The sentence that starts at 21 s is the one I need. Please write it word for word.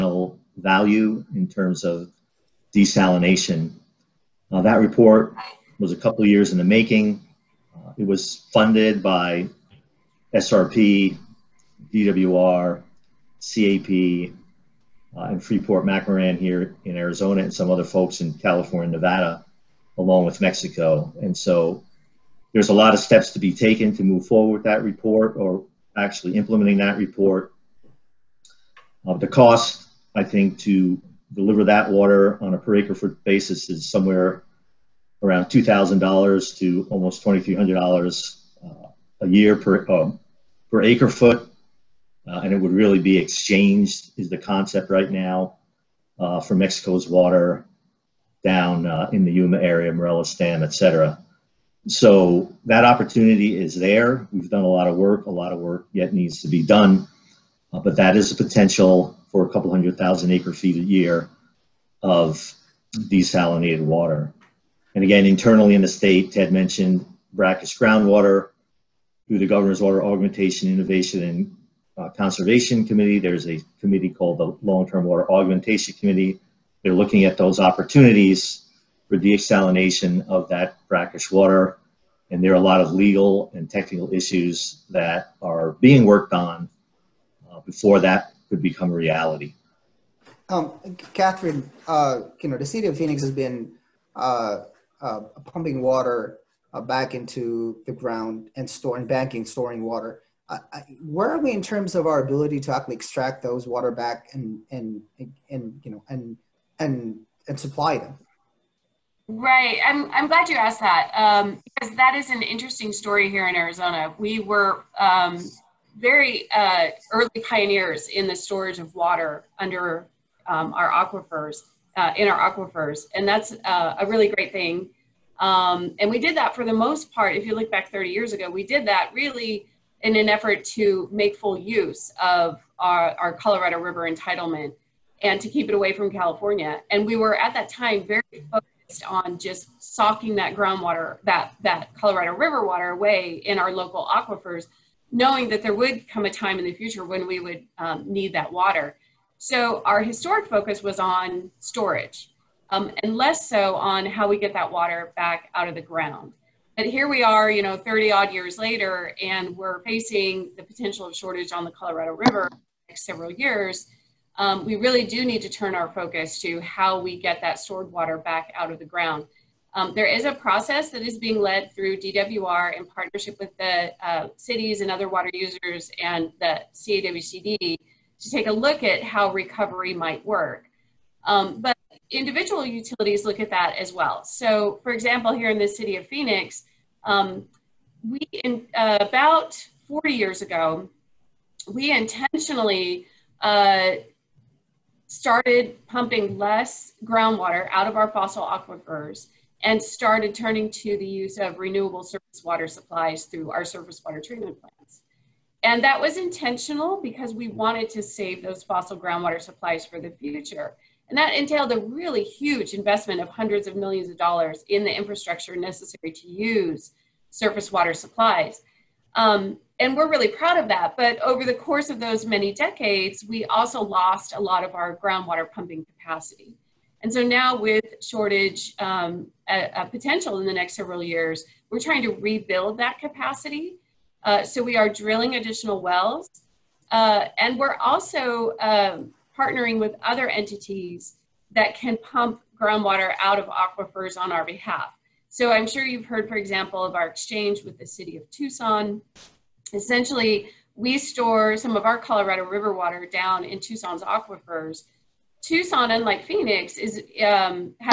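And so there's a lot of steps to be taken to move forward that report or actually implementing that report.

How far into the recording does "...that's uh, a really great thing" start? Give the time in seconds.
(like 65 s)
123 s.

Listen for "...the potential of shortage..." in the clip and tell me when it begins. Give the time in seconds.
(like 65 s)
160 s.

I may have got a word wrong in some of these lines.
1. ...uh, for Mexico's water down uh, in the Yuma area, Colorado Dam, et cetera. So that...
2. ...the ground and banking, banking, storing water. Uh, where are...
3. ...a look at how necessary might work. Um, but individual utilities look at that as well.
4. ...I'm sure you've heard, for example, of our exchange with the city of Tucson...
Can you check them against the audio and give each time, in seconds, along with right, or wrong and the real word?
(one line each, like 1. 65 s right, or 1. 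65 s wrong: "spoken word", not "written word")
1. 46 s wrong: "Morelos", not "Colorado"
2. 97 s wrong: "storing", not "banking"
3. 178 s wrong: "recovery", not "necessary"
4. 245 s right.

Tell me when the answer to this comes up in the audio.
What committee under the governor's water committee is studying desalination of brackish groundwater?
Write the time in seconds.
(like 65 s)
74 s.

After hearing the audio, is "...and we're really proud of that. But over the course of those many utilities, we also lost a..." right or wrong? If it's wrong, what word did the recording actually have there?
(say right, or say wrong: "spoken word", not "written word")
wrong: "decades", not "utilities".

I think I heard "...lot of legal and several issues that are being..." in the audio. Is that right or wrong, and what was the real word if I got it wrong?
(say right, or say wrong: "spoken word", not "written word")
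wrong: "technical", not "several".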